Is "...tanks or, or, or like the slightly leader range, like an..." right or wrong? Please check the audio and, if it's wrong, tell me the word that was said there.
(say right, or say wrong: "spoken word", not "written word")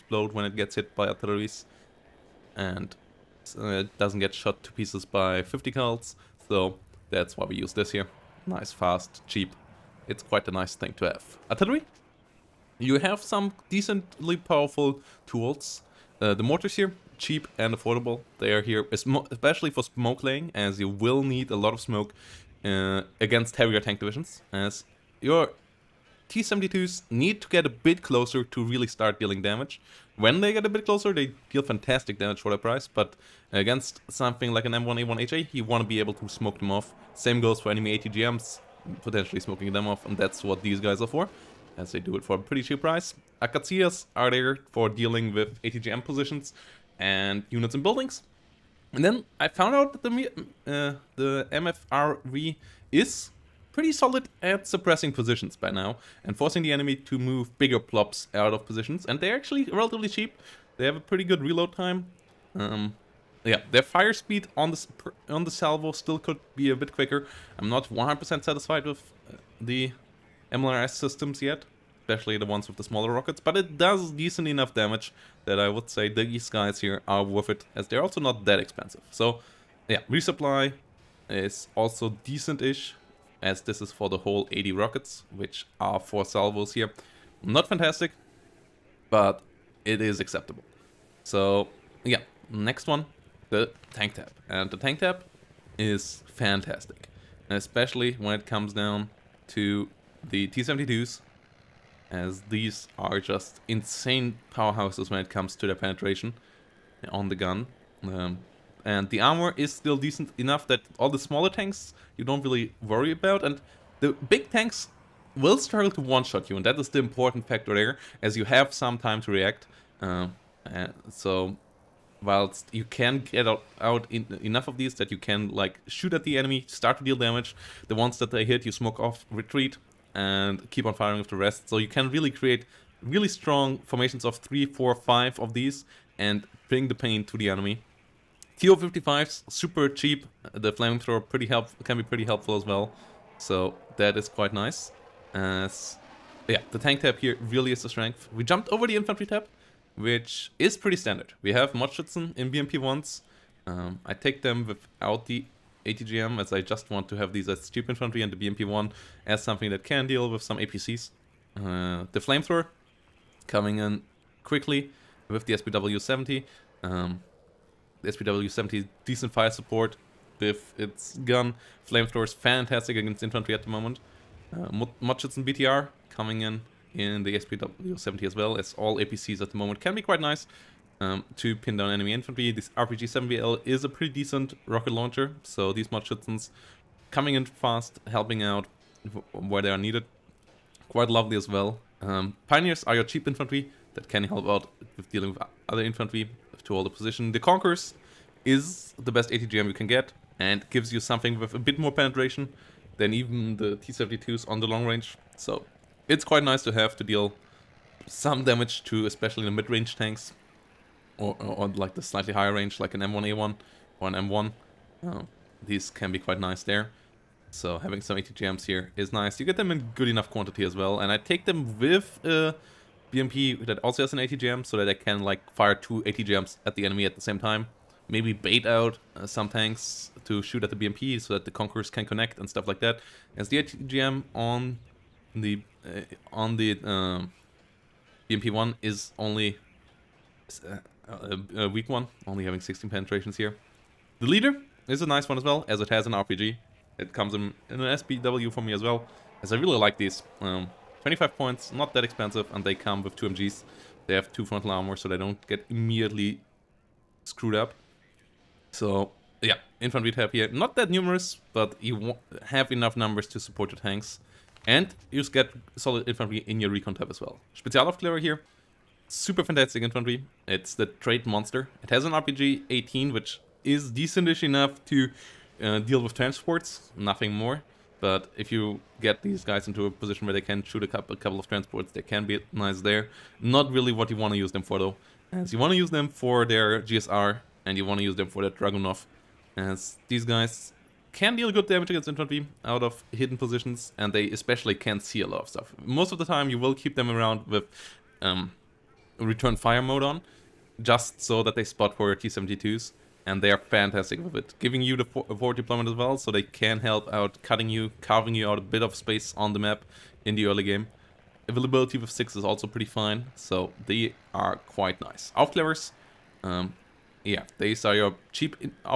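wrong: "higher", not "leader".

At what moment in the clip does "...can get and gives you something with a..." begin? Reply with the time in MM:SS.
03:19.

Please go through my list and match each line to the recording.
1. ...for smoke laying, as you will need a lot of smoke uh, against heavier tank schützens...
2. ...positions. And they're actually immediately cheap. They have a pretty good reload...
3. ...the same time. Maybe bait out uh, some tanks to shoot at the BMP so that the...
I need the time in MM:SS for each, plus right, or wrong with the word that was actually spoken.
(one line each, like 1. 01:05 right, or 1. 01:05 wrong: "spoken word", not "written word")
1. 00:19 wrong: "divisions", not "schützens"
2. 00:58 wrong: "relatively", not "immediately"
3. 03:47 right.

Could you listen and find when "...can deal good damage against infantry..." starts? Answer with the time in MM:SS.
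04:51.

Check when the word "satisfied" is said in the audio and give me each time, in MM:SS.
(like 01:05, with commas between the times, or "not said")
01:08.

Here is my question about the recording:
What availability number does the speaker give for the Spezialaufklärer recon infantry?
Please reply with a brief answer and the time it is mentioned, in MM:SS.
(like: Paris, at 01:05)
6, at 05:12.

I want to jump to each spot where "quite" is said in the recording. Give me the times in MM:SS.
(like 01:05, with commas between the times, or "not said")
00:10, 02:24, 03:00, 03:10, 03:26, 03:36, 05:14.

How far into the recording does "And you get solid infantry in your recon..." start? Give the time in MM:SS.
04:24.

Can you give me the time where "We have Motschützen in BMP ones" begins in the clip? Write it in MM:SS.
02:31.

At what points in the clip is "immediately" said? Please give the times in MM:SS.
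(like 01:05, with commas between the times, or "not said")
04:15.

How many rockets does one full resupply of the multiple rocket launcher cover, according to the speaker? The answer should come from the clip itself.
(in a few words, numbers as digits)
80.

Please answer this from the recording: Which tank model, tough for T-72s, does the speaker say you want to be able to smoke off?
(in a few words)
M1A1HA.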